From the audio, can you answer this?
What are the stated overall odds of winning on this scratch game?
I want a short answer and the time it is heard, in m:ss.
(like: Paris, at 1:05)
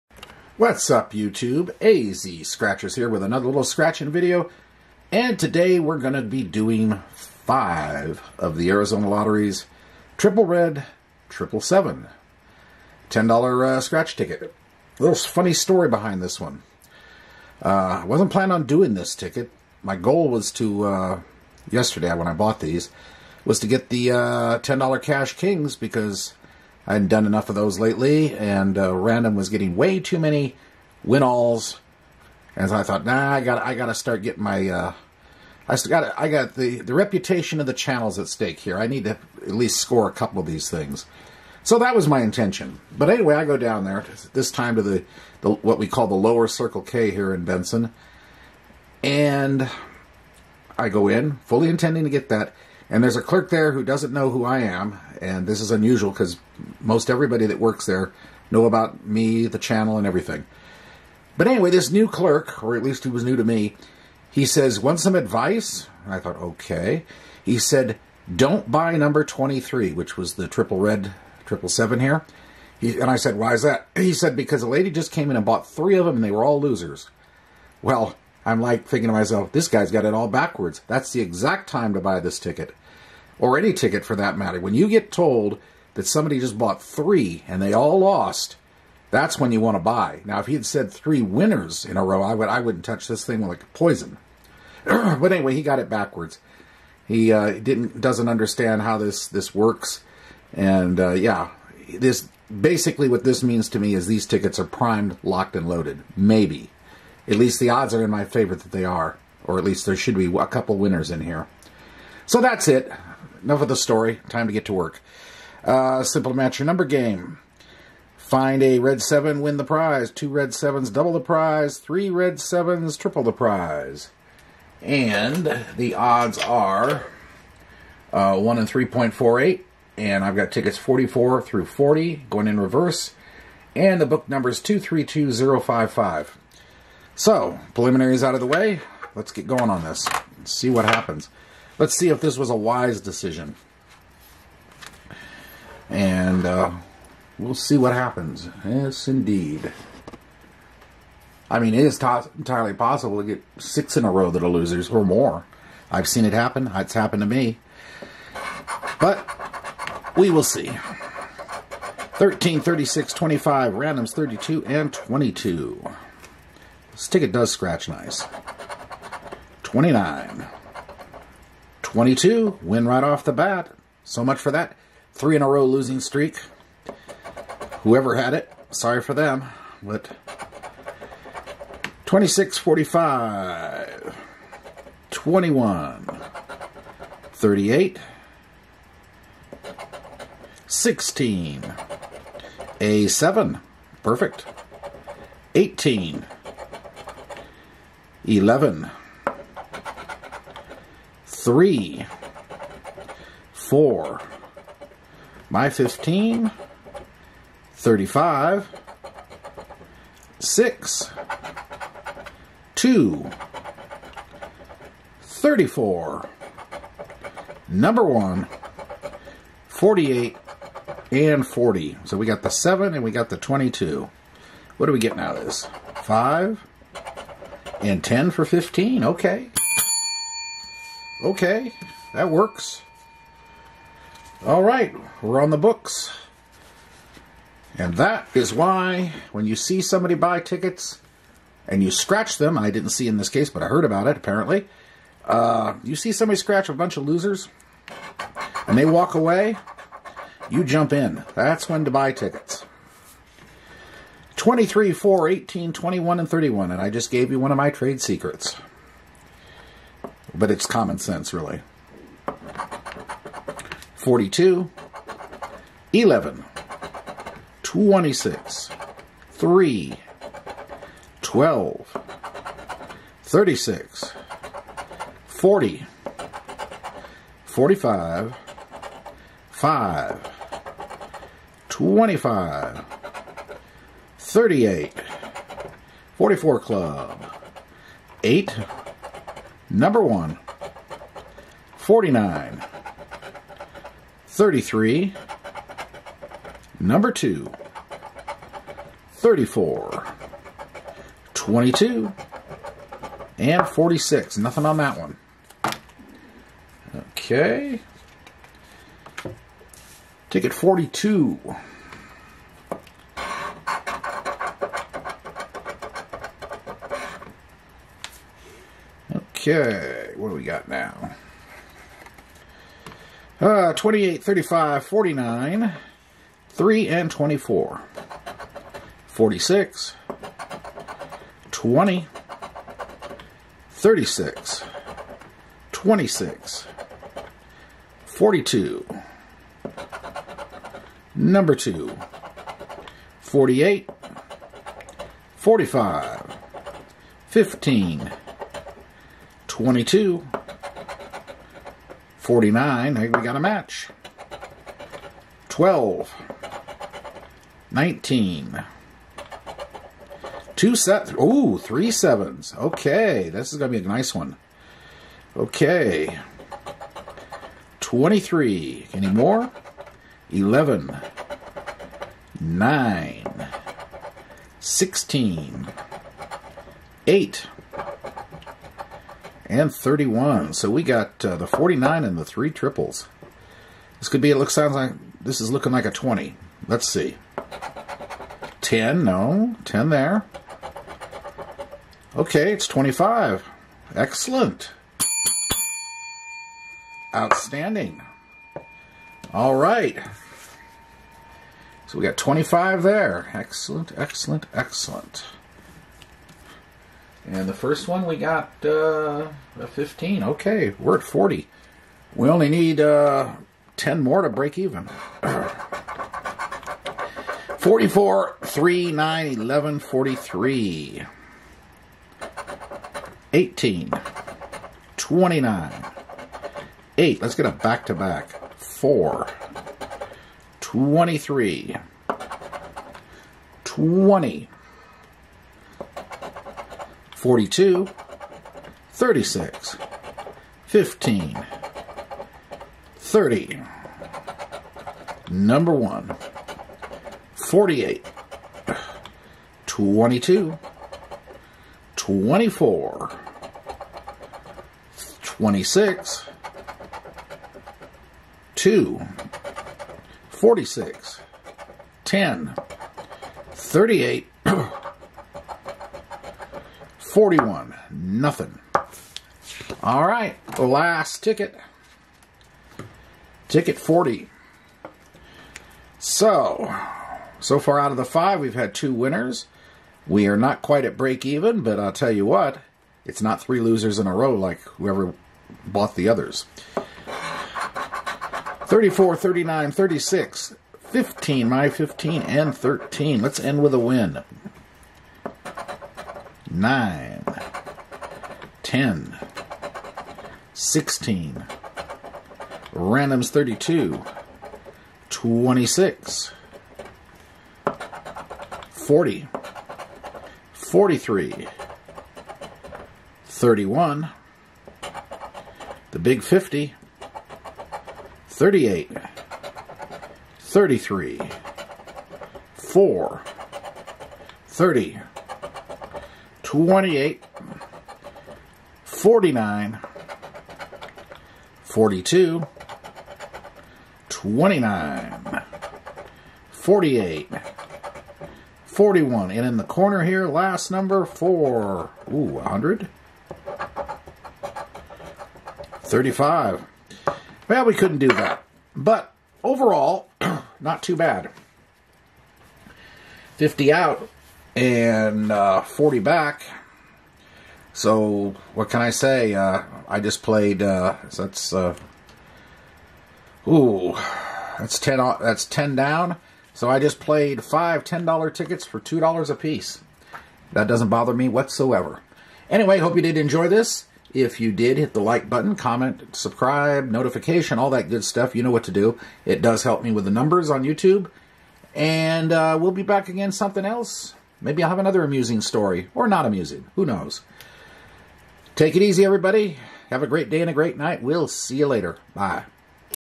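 1 in 3.48, at 2:08.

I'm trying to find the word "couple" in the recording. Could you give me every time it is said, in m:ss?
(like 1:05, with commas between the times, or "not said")
0:40, 1:50.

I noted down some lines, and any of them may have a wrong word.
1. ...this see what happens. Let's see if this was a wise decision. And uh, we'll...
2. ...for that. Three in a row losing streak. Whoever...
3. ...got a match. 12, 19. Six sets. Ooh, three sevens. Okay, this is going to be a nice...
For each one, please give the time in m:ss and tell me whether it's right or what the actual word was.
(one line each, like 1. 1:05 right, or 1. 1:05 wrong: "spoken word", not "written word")
1. 2:19 right
2. 2:54 right
3. 5:53 wrong: "Two", not "Six".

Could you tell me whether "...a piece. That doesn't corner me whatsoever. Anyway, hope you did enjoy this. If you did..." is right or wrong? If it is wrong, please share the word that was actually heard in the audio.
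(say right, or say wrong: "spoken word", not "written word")
wrong: "bother", not "corner".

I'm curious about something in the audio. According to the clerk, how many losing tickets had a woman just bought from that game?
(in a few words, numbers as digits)
3.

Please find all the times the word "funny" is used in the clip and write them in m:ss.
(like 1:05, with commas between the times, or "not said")
0:15.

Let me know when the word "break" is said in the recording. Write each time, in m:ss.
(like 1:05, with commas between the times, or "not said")
6:54, 8:00.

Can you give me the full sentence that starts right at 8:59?
And in the corner here, last number, 4.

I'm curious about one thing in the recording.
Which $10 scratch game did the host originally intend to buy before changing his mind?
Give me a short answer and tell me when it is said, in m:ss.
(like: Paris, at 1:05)
Cash Kings, at 0:25.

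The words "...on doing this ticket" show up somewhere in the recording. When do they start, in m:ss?
0:18.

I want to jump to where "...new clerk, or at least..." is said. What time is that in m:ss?
1:01.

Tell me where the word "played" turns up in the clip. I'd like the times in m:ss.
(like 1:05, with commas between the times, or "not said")
9:20, 9:26.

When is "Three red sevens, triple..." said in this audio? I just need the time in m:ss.
2:01.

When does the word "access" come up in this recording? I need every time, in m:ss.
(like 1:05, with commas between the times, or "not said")
not said.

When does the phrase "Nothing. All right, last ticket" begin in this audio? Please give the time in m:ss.
7:47.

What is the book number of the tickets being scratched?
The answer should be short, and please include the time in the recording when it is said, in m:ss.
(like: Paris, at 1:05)
232055, at 2:14.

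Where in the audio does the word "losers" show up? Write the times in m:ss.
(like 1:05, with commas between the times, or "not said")
1:16, 2:34, 4:07, 8:03.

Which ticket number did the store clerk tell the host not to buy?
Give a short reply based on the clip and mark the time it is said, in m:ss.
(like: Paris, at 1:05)
23, at 1:08.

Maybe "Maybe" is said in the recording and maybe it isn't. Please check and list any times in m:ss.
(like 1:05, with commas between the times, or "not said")
1:46, 9:44.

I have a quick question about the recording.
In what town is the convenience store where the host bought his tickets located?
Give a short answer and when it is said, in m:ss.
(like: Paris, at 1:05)
Benson, at 0:47.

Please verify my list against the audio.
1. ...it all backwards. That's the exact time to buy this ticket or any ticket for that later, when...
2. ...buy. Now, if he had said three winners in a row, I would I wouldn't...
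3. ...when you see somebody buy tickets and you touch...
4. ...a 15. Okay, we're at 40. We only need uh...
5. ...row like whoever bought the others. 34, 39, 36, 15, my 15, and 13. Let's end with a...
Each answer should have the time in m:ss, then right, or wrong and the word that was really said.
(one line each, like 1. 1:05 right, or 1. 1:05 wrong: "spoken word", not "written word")
1. 1:20 wrong: "matter", not "later"
2. 1:29 right
3. 3:59 wrong: "scratch", not "touch"
4. 6:49 right
5. 8:04 right.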